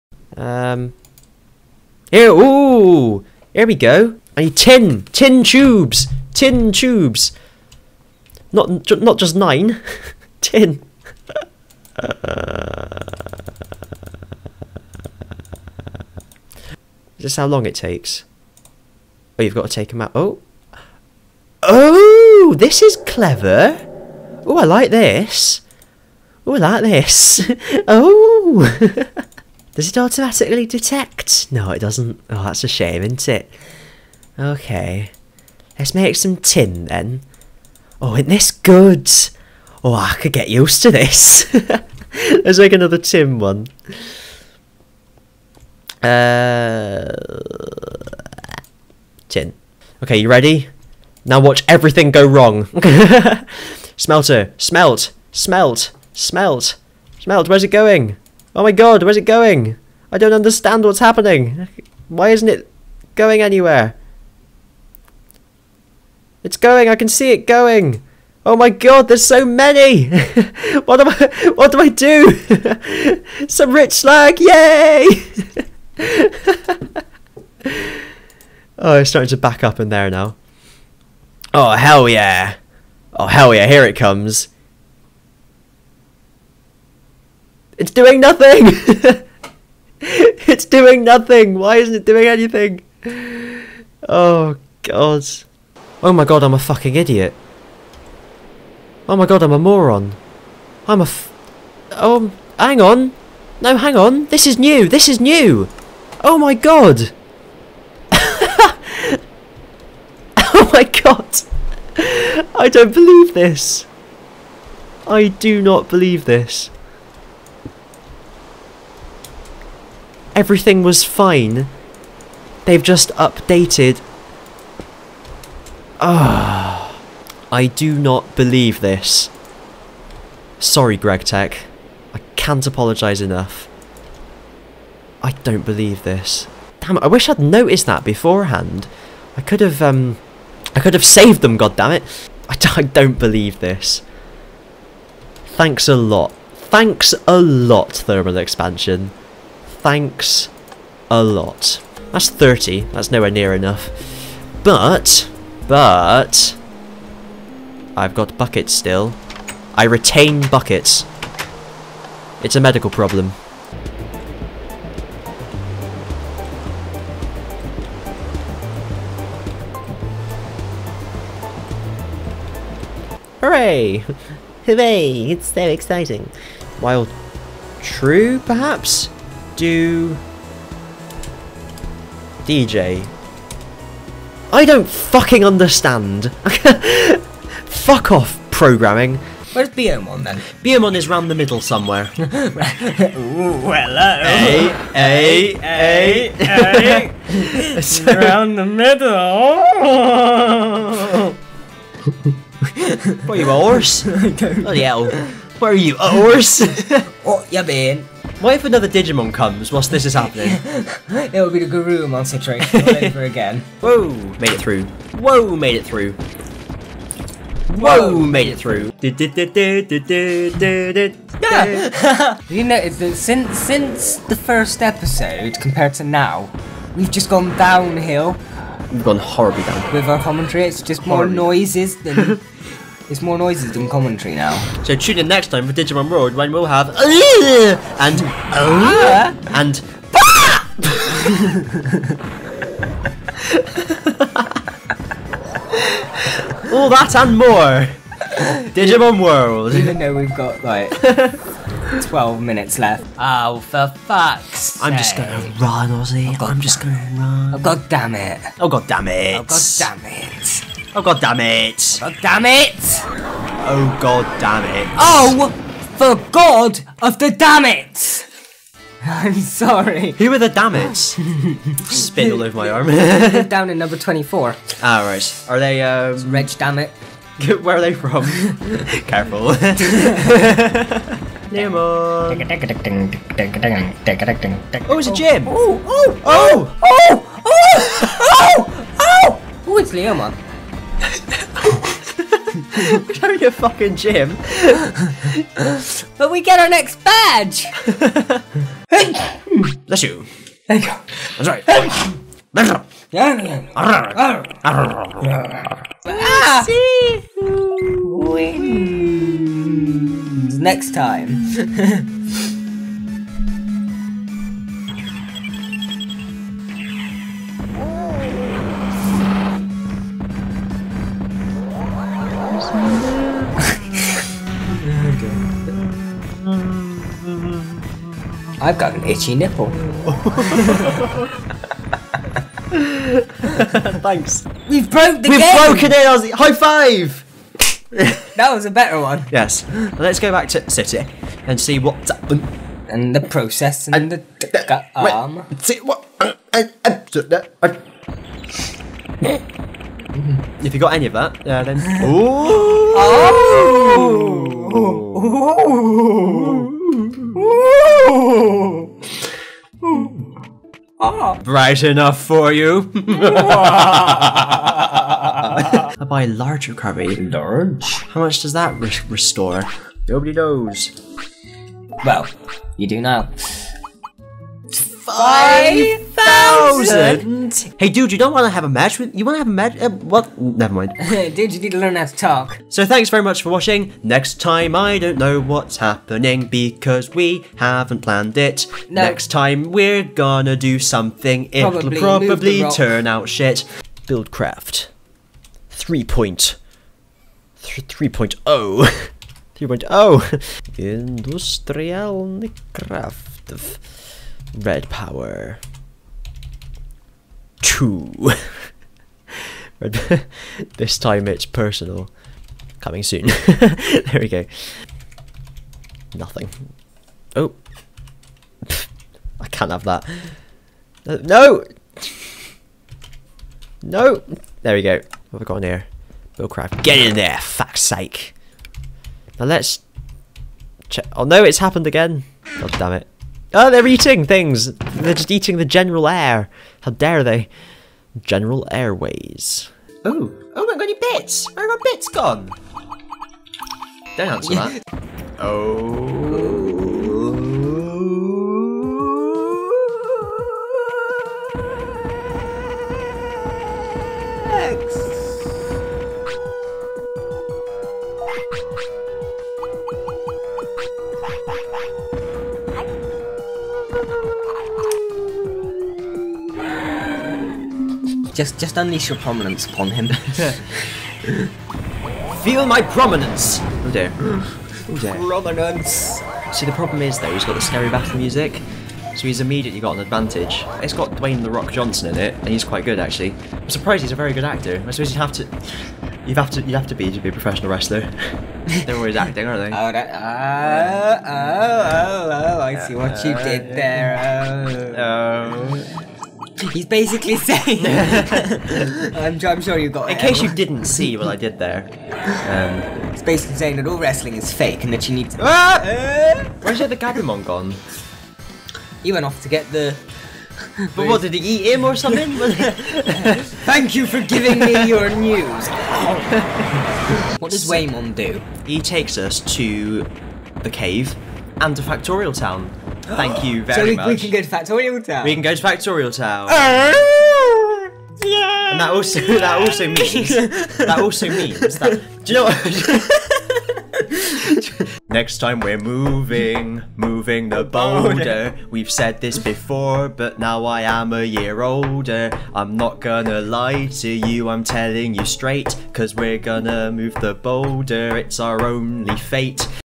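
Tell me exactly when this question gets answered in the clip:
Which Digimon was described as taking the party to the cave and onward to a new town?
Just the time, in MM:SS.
08:37.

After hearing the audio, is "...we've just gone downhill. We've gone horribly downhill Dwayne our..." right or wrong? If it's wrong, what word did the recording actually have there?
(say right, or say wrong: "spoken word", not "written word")
wrong: "With", not "Dwayne".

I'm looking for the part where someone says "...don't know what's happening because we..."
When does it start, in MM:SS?
06:24.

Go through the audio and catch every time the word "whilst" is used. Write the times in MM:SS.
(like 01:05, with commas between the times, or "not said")
03:29.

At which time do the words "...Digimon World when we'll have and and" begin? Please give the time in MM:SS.
03:55.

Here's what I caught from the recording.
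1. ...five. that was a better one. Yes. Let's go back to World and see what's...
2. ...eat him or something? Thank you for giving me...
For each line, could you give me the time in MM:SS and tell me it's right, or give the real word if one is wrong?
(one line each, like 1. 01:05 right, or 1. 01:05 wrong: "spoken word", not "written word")
1. 05:36 wrong: "City", not "World"
2. 08:31 right.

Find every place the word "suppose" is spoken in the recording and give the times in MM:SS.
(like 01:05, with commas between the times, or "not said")
08:04.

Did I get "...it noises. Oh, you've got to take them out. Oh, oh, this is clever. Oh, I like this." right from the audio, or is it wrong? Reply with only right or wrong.
wrong.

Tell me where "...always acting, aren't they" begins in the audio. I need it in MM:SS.
08:08.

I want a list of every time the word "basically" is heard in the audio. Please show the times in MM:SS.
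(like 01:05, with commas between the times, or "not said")
08:16, 08:23.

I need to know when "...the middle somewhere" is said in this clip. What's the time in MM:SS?
03:11.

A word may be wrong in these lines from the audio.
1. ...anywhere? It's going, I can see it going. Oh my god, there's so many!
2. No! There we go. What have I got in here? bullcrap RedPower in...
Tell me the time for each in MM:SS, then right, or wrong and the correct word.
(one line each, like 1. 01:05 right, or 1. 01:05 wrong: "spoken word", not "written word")
1. 01:03 right
2. 07:03 wrong: "Get", not "RedPower".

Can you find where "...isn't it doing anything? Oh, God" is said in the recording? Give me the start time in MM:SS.
01:31.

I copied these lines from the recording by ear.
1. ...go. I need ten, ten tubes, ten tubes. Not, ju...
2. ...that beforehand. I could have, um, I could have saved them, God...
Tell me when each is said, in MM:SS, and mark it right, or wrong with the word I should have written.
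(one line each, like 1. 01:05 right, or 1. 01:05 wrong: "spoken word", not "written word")
1. 00:03 right
2. 02:17 right.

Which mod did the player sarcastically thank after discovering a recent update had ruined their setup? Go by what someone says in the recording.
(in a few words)
Thermal Expansion.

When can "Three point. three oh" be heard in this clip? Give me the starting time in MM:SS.
06:35.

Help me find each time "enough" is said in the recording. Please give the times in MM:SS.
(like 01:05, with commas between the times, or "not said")
02:13, 02:33, 06:01.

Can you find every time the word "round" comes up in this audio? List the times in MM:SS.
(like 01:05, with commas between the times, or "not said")
03:11, 03:18.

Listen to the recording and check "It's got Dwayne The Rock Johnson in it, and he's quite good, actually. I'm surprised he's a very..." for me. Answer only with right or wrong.
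right.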